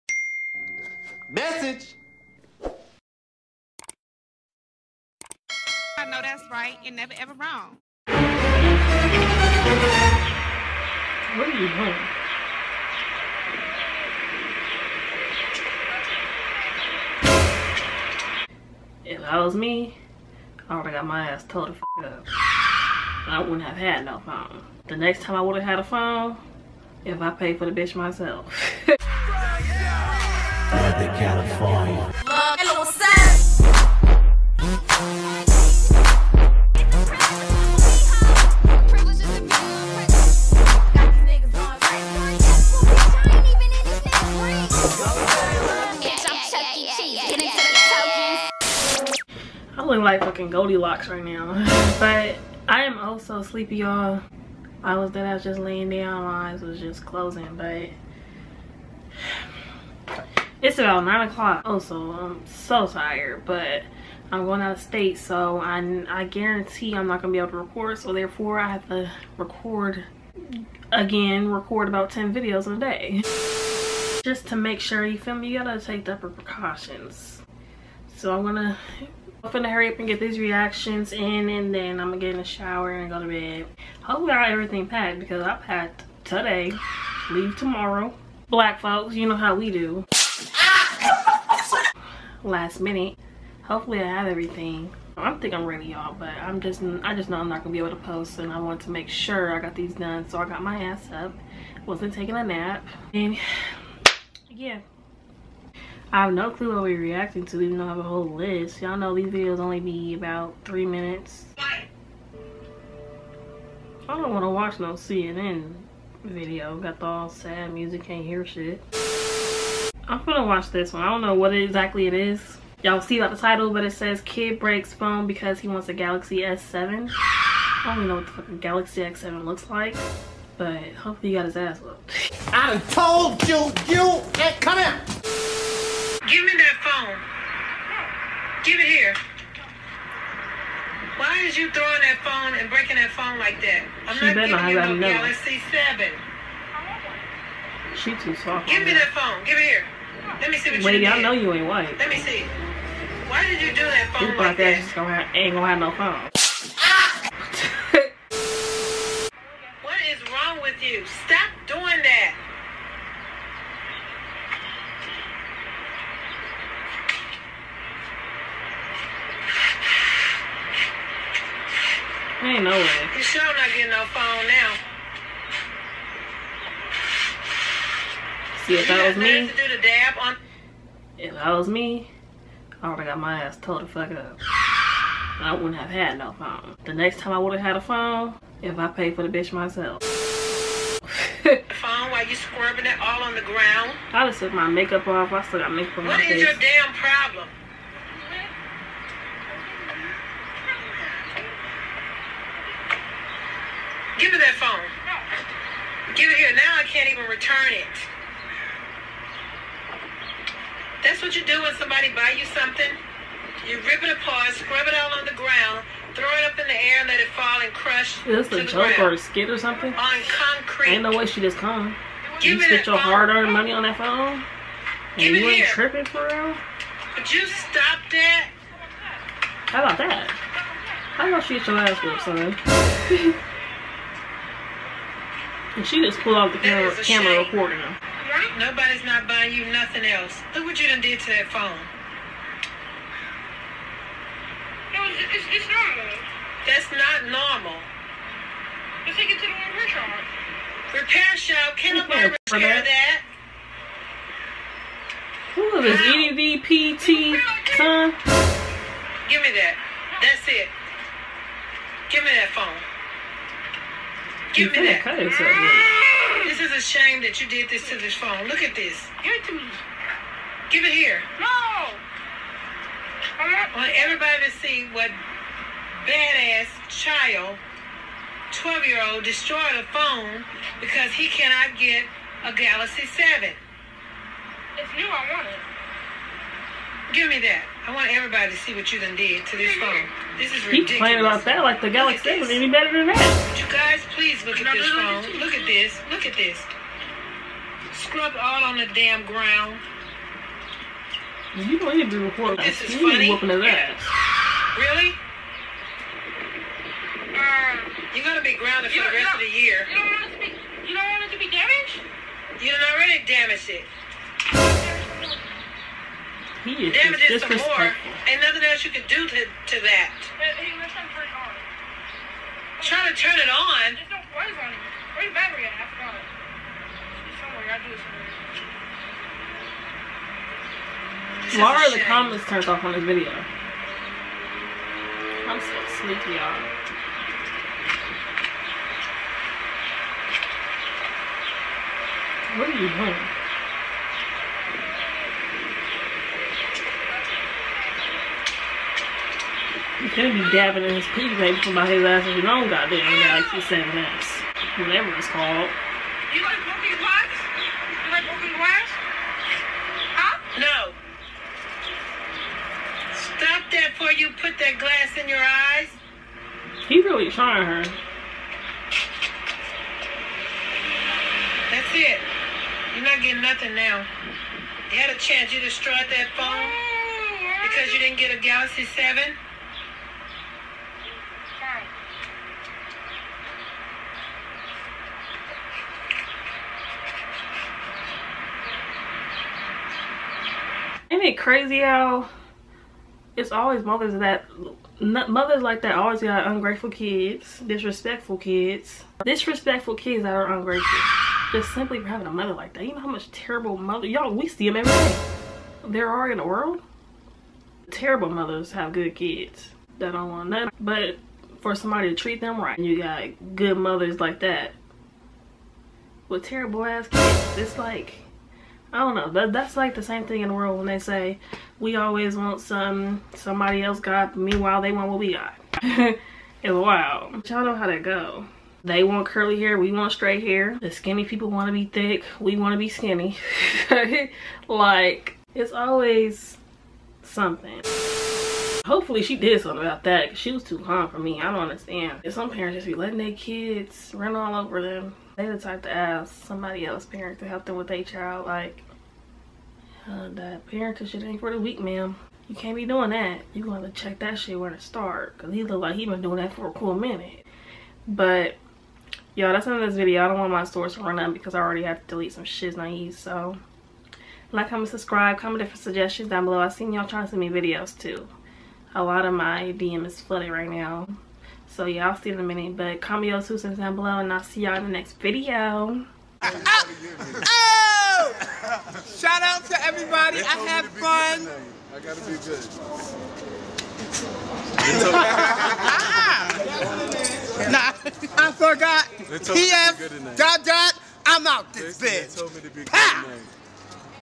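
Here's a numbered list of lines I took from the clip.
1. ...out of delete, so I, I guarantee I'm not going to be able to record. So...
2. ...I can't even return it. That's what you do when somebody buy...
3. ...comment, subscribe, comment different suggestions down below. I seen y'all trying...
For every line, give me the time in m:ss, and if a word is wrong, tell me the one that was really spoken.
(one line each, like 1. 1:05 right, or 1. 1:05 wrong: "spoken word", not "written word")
1. 1:04 wrong: "state", not "delete"
2. 3:26 right
3. 7:44 right.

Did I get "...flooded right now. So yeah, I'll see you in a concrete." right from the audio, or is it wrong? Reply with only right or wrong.
wrong.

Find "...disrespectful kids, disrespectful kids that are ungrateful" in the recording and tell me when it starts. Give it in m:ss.
6:37.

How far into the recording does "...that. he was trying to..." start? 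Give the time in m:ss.
5:19.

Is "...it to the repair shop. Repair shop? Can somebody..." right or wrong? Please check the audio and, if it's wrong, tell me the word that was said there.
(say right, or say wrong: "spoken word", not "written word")
wrong: "nobody", not "somebody".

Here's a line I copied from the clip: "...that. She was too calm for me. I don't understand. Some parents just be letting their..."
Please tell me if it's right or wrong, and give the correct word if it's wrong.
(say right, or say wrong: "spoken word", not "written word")
right.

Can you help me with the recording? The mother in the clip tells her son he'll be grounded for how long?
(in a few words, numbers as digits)
The rest of the year.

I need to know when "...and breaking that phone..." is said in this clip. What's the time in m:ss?
2:22.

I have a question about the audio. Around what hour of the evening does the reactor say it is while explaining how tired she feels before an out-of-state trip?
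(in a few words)
9 o'clock.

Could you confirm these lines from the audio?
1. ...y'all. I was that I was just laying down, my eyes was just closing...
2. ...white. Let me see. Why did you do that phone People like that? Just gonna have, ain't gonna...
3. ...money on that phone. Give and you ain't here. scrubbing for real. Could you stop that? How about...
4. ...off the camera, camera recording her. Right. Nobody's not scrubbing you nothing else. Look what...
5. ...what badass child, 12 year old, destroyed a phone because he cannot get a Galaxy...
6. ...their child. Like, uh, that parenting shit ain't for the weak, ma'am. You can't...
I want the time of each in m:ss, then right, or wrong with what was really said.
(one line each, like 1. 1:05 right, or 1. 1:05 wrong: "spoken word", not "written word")
1. 0:53 right
2. 2:31 right
3. 3:43 wrong: "tripping", not "scrubbing"
4. 3:56 wrong: "buying", not "scrubbing"
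5. 4:34 right
6. 7:27 right.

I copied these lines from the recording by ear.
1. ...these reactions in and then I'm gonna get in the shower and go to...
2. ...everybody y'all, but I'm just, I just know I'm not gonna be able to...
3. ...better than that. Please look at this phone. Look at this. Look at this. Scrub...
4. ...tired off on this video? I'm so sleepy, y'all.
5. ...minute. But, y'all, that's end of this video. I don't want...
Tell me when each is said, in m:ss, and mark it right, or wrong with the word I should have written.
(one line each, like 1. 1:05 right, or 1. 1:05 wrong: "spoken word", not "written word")
1. 1:20 right
2. 1:35 wrong: "ready", not "everybody"
3. 4:52 right
4. 5:32 wrong: "turned", not "tired"
5. 7:36 right.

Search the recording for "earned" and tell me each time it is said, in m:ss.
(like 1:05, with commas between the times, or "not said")
3:42.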